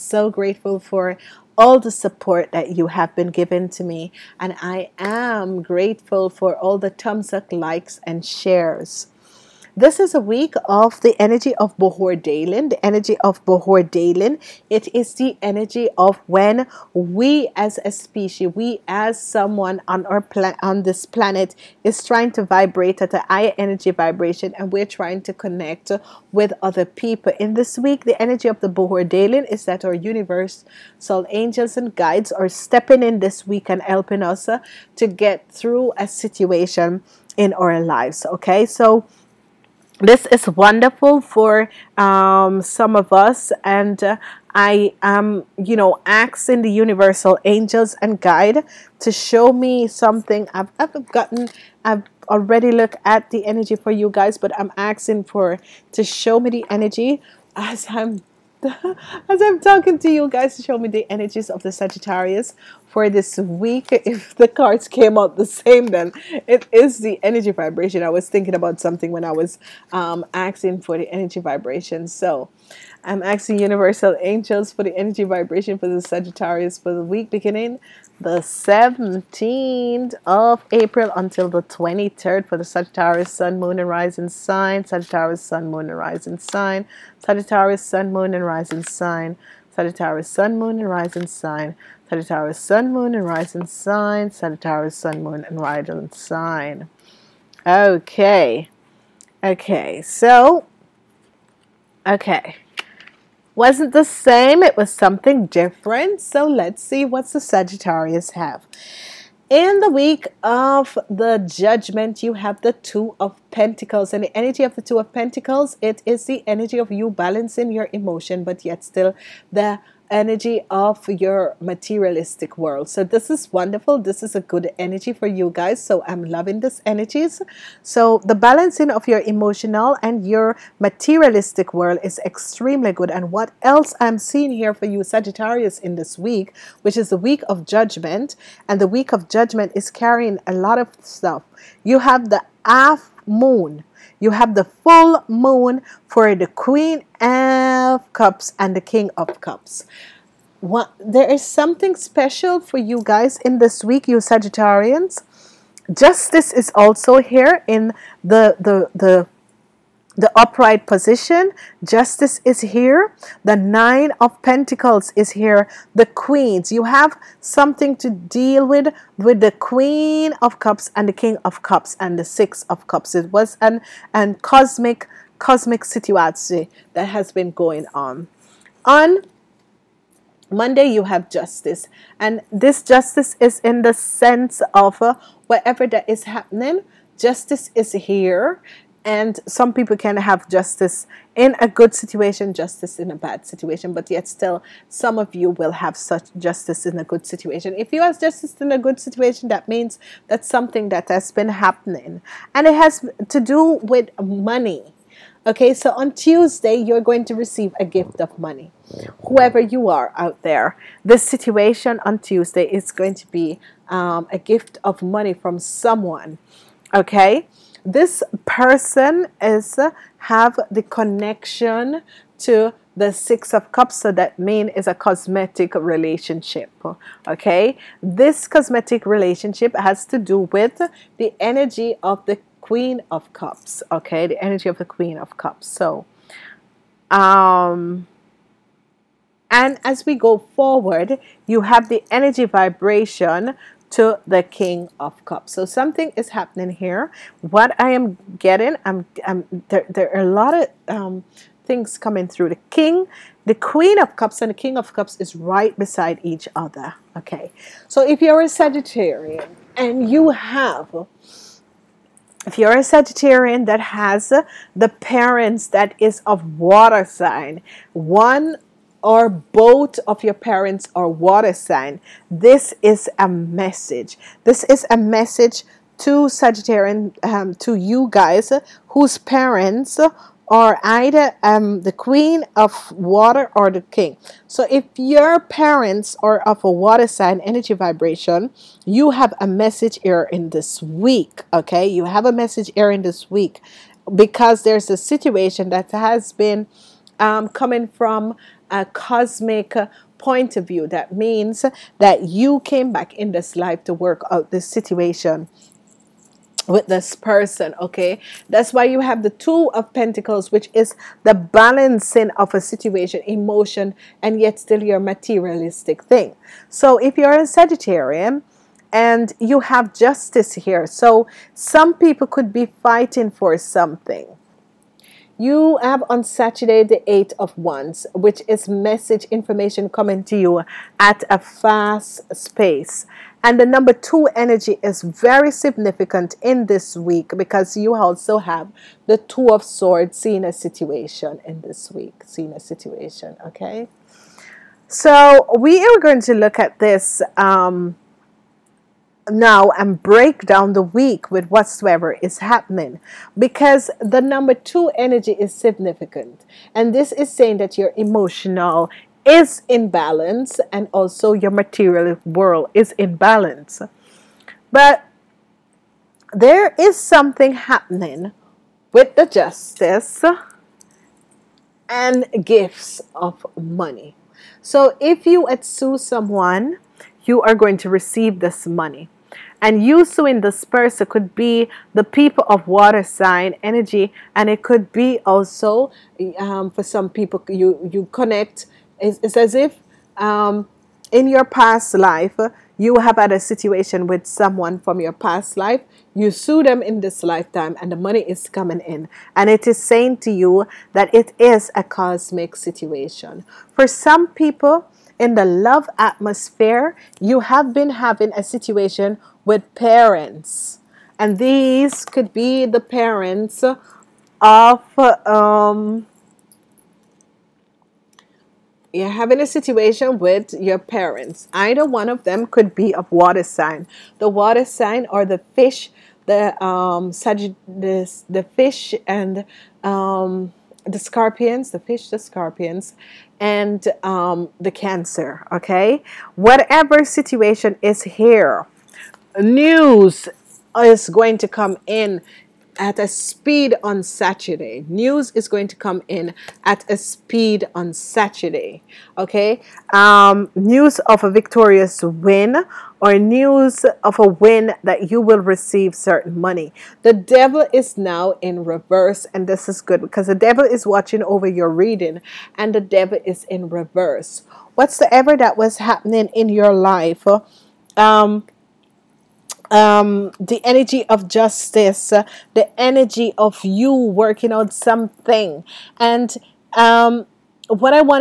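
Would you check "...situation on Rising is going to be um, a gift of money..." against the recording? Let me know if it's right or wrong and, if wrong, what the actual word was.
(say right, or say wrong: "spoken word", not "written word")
wrong: "Tuesday", not "Rising".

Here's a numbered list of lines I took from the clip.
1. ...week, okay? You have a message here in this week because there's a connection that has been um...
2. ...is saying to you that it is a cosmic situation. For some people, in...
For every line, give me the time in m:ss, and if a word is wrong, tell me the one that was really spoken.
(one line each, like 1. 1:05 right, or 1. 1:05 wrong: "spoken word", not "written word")
1. 4:50 wrong: "situation", not "connection"
2. 6:39 right.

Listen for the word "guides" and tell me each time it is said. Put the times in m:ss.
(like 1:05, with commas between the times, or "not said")
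0:31, 0:48.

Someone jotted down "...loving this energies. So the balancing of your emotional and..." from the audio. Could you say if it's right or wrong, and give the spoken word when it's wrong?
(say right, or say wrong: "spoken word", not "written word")
right.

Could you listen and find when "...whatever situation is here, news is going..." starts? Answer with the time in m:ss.
7:16.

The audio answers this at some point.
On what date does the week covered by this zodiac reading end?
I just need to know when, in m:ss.
1:21.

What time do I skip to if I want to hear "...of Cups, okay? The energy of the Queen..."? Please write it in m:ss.
3:53.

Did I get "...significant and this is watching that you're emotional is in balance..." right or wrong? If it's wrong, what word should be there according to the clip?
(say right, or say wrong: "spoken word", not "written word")
wrong: "saying", not "watching".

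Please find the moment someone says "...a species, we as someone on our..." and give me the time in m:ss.
0:17.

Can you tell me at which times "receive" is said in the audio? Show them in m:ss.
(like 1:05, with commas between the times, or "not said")
3:27, 6:17, 7:35.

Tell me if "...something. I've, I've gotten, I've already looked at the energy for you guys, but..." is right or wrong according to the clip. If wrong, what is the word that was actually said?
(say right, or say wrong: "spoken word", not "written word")
right.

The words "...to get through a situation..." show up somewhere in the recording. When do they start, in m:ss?
0:34.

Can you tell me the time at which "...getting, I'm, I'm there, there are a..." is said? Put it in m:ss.
4:08.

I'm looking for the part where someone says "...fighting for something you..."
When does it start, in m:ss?
5:22.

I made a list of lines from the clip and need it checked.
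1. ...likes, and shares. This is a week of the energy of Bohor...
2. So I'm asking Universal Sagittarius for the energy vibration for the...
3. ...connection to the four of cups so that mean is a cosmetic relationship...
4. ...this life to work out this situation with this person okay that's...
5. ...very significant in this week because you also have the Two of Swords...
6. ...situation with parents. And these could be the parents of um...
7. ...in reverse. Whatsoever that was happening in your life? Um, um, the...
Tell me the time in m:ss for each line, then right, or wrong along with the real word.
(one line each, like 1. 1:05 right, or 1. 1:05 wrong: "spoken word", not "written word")
1. 0:07 right
2. 1:12 wrong: "Angels", not "Sagittarius"
3. 3:40 wrong: "six", not "four"
4. 5:03 right
5. 5:35 right
6. 6:48 right
7. 7:43 right.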